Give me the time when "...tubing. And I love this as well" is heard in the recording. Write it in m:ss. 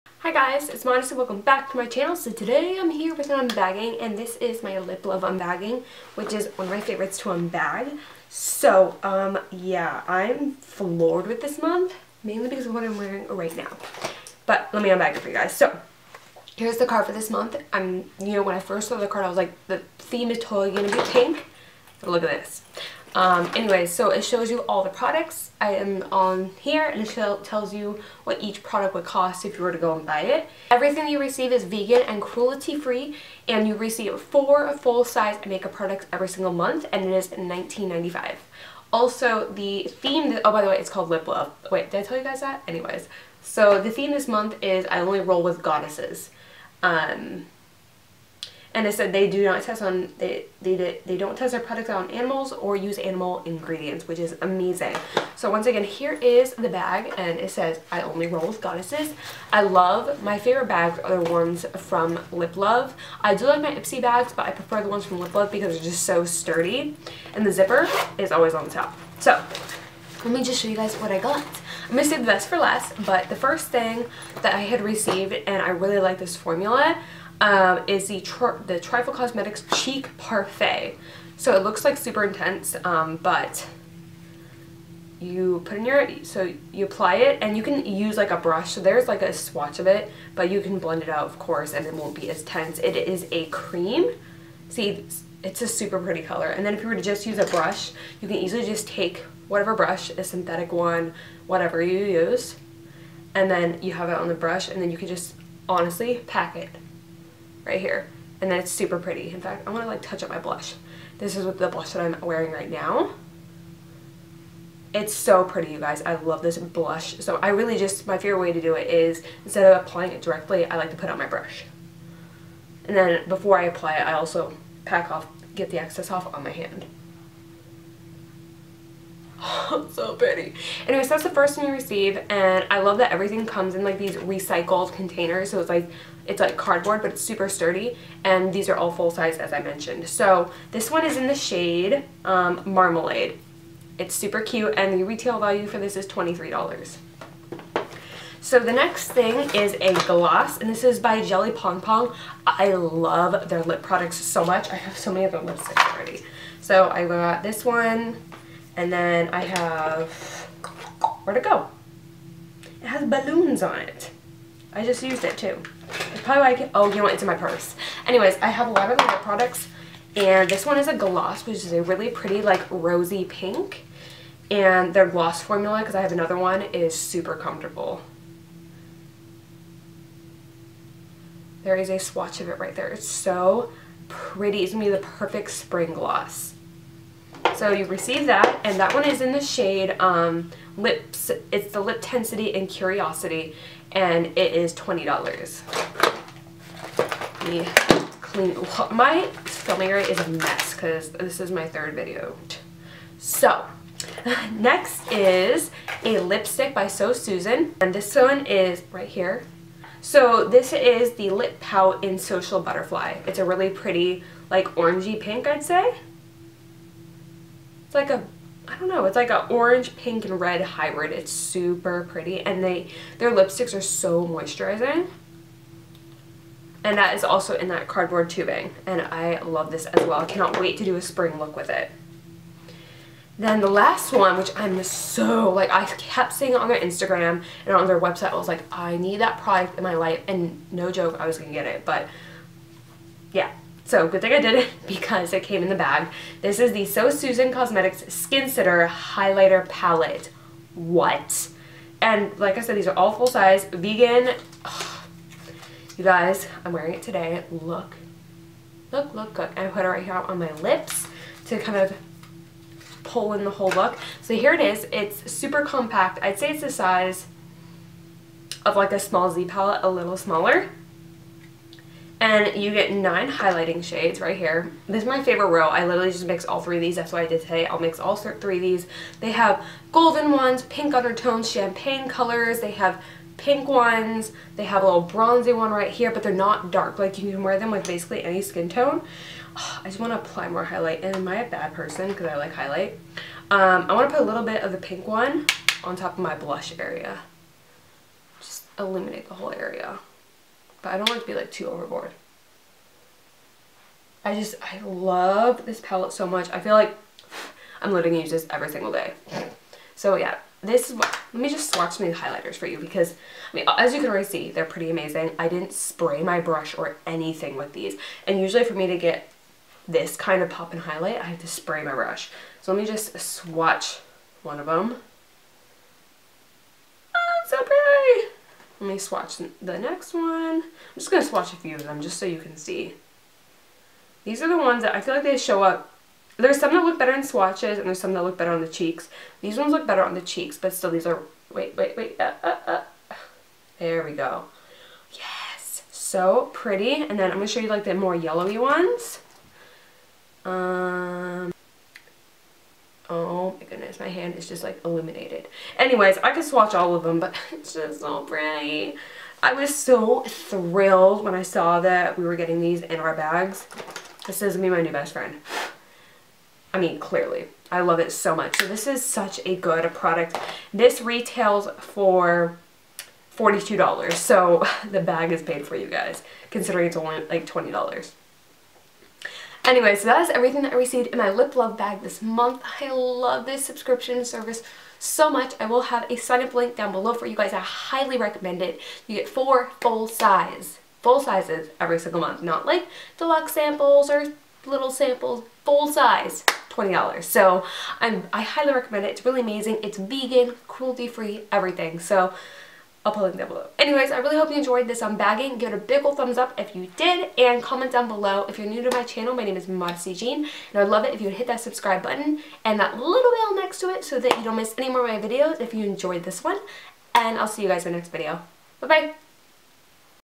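3:48.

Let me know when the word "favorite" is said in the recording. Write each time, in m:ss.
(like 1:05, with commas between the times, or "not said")
0:06, 1:00, 1:58, 4:35.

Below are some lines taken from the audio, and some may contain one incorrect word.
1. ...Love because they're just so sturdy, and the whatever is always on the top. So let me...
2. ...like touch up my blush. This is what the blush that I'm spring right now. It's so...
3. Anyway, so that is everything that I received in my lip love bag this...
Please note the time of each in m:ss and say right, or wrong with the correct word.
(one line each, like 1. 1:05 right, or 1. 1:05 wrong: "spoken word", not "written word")
1. 1:05 wrong: "zipper", not "whatever"
2. 1:49 wrong: "wearing", not "spring"
3. 6:19 right.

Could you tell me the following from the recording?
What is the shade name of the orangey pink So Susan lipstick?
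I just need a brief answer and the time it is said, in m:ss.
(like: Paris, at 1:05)
Social Butterfly, at 3:32.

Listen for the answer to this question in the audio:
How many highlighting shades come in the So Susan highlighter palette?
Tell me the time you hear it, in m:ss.
4:32.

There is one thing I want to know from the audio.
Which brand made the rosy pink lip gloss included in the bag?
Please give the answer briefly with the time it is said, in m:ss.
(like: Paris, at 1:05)
Jelly Pong Pong, at 2:31.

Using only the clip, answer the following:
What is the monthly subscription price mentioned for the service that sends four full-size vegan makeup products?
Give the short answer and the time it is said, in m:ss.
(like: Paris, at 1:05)
$19.95, at 0:37.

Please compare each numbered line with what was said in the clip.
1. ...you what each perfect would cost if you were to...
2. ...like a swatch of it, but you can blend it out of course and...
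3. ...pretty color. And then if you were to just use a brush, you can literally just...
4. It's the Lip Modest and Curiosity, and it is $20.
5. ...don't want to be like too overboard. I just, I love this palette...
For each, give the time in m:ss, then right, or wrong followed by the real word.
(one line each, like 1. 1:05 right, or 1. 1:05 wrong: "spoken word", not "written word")
1. 0:27 wrong: "product", not "perfect"
2. 1:29 right
3. 1:35 wrong: "easily", not "literally"
4. 3:11 wrong: "Tensity", not "Modest"
5. 5:00 right.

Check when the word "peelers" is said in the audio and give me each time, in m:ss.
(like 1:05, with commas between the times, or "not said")
not said.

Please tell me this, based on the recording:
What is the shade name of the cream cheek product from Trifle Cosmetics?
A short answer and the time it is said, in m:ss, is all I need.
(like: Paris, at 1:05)
Marmalade, at 2:22.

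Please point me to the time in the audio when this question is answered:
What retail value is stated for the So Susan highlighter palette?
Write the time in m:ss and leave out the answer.
6:13.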